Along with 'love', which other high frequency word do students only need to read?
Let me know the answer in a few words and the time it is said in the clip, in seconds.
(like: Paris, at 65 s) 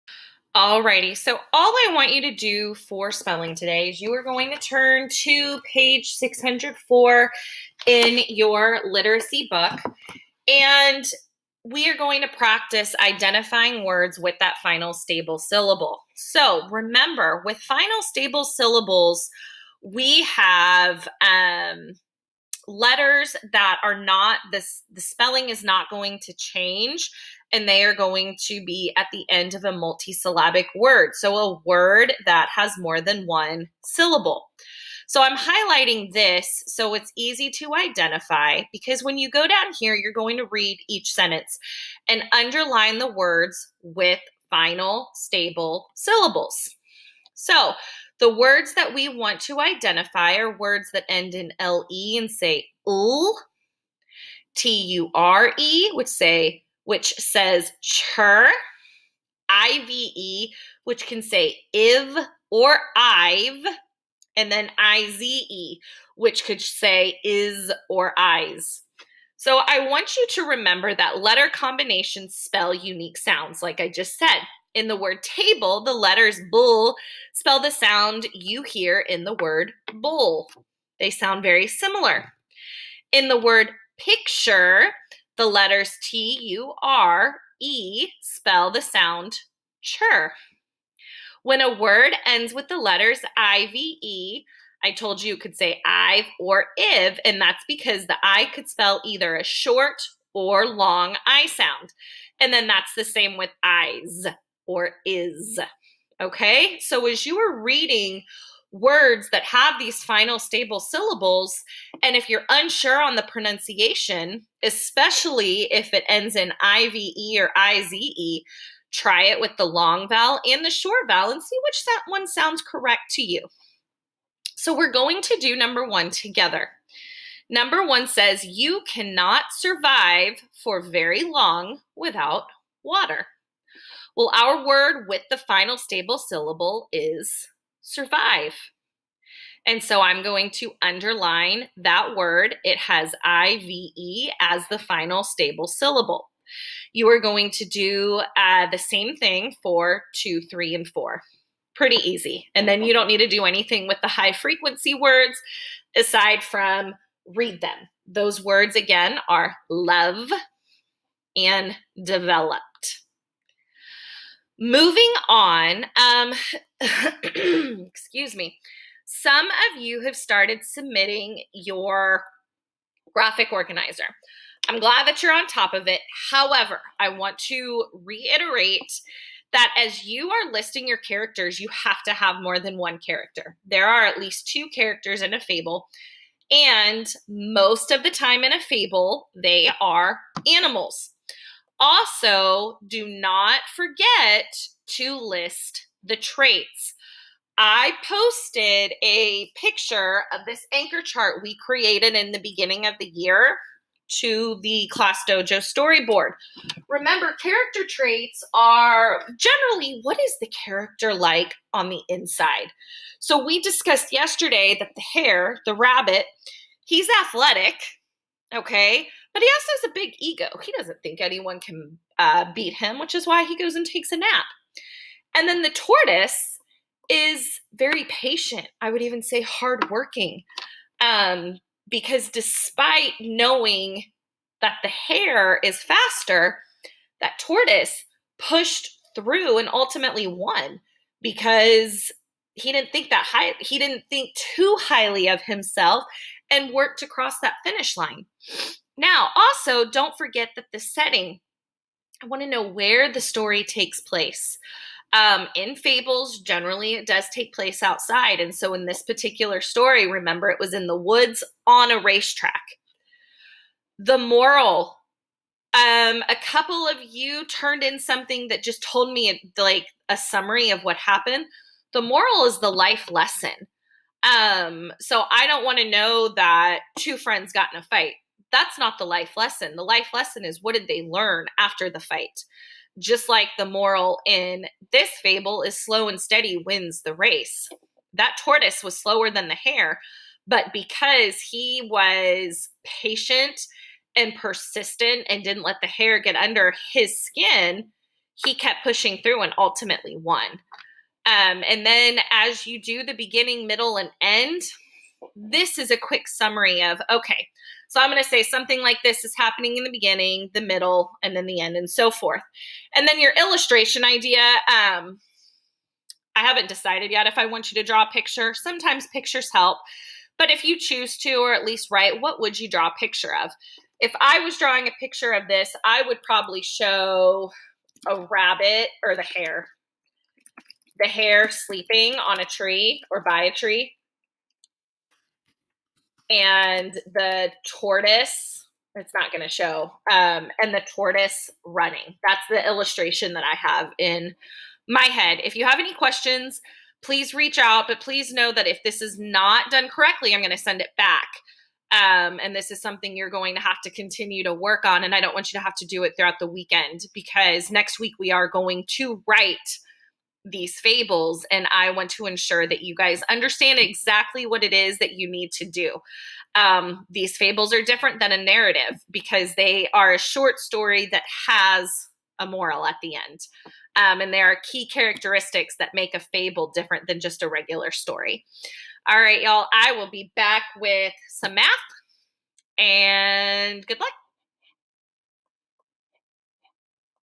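developed, at 162 s.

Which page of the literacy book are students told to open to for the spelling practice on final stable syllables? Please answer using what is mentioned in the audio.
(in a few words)
604.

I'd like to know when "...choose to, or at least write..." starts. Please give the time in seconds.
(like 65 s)
320 s.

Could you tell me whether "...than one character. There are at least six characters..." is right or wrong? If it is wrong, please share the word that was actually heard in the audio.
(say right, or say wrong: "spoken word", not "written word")
wrong: "two", not "six".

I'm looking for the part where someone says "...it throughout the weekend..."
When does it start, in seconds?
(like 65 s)
356 s.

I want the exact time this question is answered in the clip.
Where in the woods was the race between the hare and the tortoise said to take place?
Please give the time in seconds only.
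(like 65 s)
261 s.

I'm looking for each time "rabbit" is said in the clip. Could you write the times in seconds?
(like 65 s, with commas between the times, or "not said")
215 s, 328 s.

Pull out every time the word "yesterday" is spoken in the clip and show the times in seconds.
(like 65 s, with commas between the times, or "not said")
214 s.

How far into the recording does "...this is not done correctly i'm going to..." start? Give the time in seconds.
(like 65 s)
348 s.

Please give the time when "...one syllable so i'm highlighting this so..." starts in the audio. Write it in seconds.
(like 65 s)
33 s.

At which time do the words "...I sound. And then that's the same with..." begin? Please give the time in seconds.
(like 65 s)
101 s.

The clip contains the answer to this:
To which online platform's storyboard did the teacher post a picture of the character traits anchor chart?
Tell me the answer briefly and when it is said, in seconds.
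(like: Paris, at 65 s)
Class Dojo, at 204 s.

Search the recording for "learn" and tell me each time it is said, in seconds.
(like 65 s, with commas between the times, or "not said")
281 s.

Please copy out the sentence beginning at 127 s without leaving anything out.
Number one says, You cannot survive for very long without water.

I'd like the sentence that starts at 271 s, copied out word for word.
The moral is the life lesson.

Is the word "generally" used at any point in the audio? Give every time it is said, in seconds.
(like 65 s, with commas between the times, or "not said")
209 s, 256 s.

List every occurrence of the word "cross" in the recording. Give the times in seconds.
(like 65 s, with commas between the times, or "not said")
247 s.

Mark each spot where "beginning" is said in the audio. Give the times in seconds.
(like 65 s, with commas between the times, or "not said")
202 s, 303 s, 309 s.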